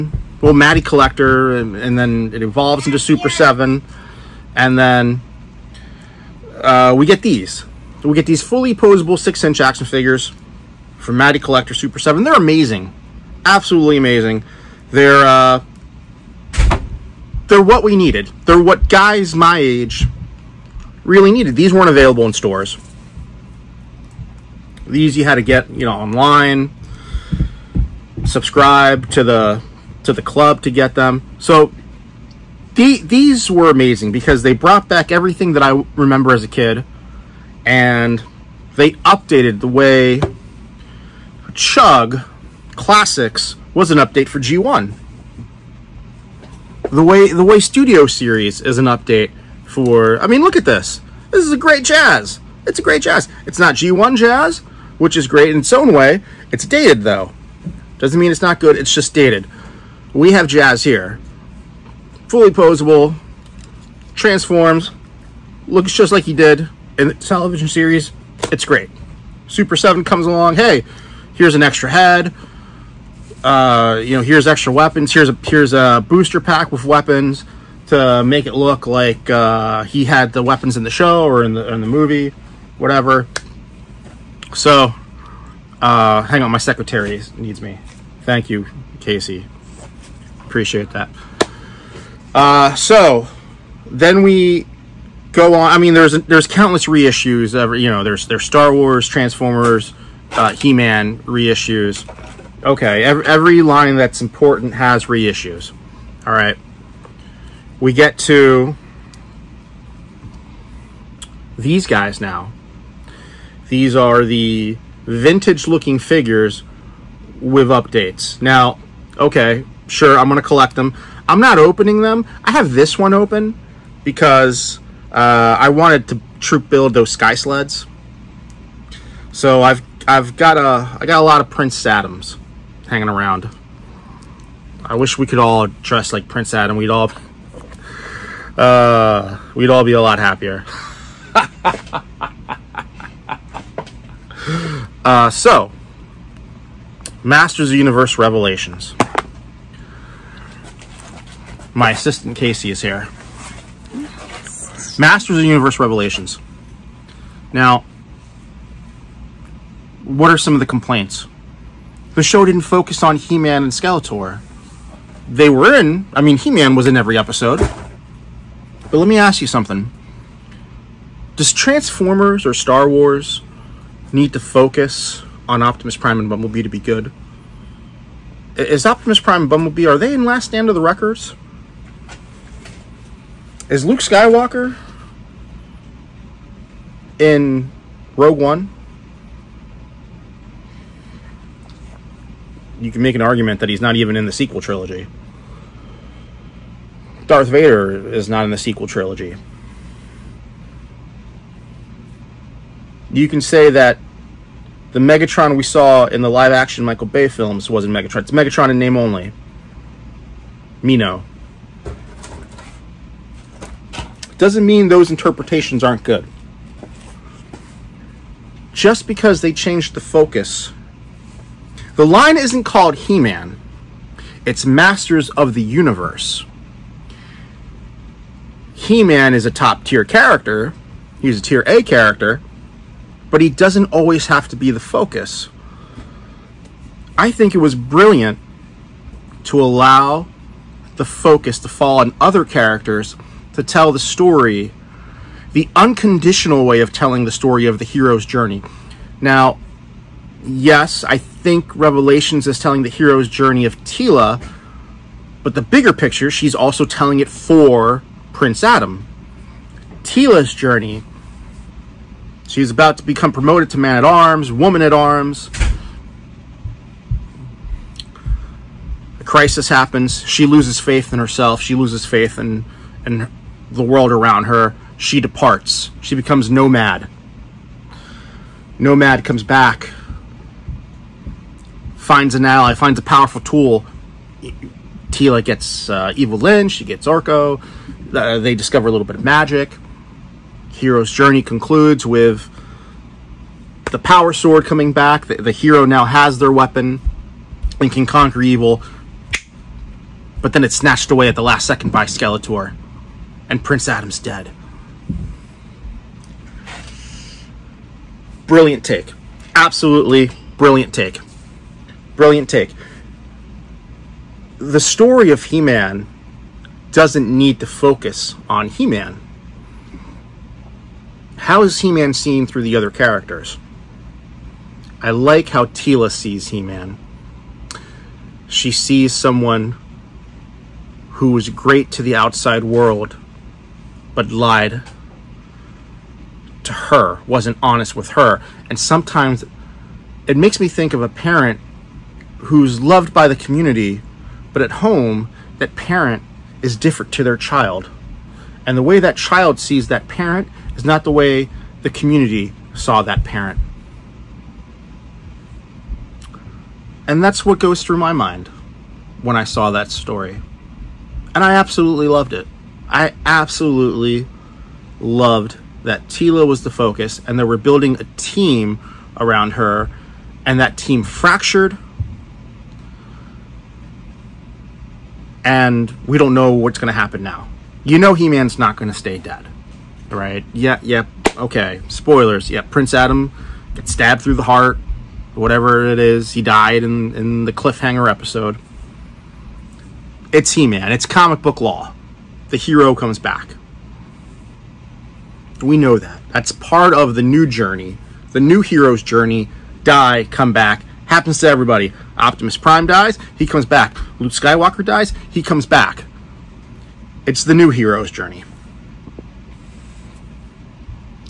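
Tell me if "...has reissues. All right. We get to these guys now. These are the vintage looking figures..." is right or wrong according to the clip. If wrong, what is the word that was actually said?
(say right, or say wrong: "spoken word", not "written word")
right.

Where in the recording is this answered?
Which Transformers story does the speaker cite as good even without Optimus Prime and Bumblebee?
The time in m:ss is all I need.
3:00.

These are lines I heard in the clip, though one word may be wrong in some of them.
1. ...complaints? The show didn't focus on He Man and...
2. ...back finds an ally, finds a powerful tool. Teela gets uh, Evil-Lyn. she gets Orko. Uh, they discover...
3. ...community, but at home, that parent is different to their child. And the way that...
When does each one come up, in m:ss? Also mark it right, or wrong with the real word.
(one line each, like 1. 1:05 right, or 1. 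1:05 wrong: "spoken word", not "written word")
1. 2:40 right
2. 4:39 right
3. 5:43 right.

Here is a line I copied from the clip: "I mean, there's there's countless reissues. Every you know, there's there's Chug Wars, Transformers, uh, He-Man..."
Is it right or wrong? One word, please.
wrong.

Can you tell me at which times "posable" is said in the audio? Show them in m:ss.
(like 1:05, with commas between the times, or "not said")
0:08, 1:02.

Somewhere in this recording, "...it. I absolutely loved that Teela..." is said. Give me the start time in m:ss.
6:02.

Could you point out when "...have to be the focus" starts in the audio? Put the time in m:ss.
3:54.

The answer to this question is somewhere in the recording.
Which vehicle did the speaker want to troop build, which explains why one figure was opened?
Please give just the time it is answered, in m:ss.
2:07.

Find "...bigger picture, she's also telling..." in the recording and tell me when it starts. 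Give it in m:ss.
4:15.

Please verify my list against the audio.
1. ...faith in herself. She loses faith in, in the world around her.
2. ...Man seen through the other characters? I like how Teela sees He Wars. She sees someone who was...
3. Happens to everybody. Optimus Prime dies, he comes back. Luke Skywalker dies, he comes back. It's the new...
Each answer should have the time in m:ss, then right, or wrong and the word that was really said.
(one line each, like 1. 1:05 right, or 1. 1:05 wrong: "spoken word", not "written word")
1. 4:30 right
2. 5:21 wrong: "Man", not "Wars"
3. 6:41 right.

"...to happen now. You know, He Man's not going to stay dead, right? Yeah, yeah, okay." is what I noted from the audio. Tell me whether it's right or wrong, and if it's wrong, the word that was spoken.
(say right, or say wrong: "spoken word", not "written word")
right.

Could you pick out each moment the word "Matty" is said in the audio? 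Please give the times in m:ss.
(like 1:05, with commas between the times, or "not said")
0:00, 0:11.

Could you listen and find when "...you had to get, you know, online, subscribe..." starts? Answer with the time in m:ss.
0:25.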